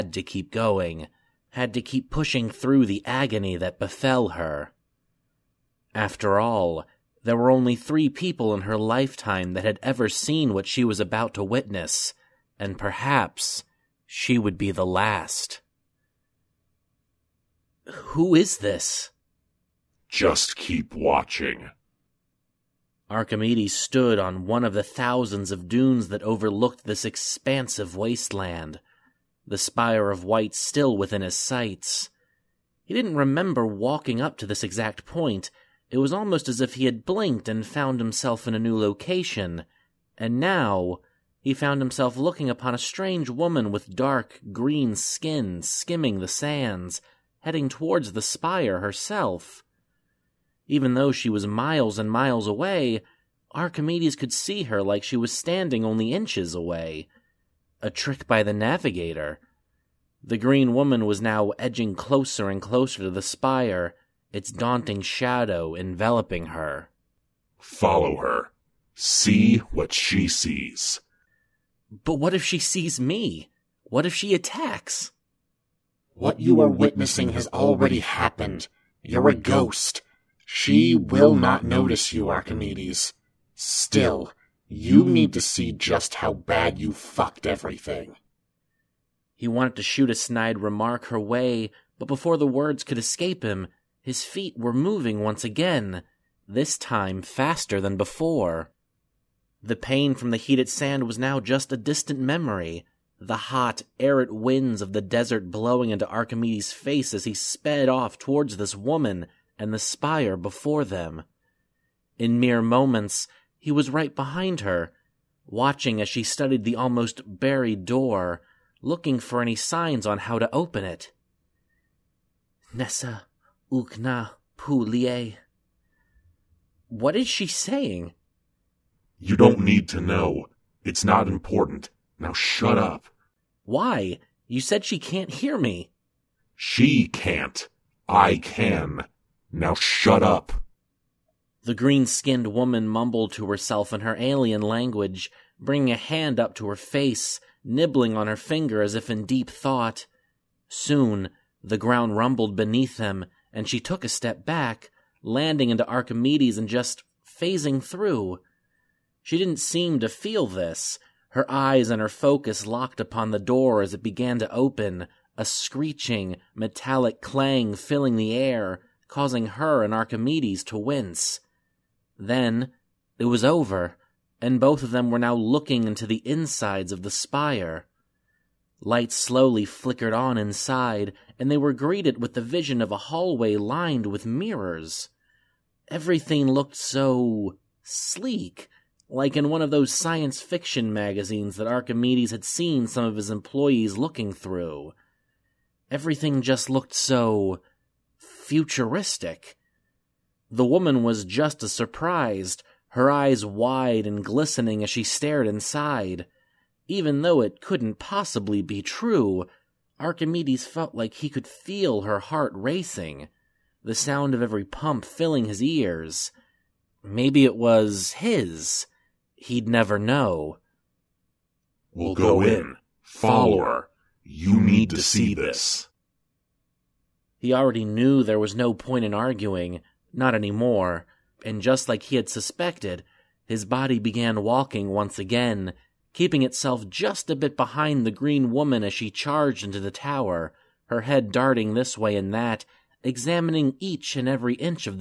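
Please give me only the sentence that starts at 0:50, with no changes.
Even though she was miles and miles away, Archimedes could see her like she was standing only inches away.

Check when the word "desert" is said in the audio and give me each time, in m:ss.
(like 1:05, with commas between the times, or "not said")
1:45.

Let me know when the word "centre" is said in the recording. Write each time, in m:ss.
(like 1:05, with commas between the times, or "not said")
not said.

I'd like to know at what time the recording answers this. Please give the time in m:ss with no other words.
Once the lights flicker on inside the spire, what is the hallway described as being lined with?
3:04.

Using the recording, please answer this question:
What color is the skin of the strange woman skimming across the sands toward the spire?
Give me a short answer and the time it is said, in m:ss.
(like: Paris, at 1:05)
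Dark green, at 0:43.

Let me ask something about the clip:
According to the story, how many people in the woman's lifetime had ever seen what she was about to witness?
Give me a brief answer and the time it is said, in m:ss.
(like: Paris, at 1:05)
3, at 0:07.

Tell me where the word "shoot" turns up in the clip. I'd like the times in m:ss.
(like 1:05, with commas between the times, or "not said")
1:29.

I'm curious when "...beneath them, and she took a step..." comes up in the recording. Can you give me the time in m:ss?
2:32.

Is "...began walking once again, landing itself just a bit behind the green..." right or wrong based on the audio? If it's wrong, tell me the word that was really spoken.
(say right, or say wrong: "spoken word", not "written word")
wrong: "keeping", not "landing".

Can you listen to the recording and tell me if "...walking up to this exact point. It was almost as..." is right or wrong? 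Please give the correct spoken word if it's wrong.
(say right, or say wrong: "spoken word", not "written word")
right.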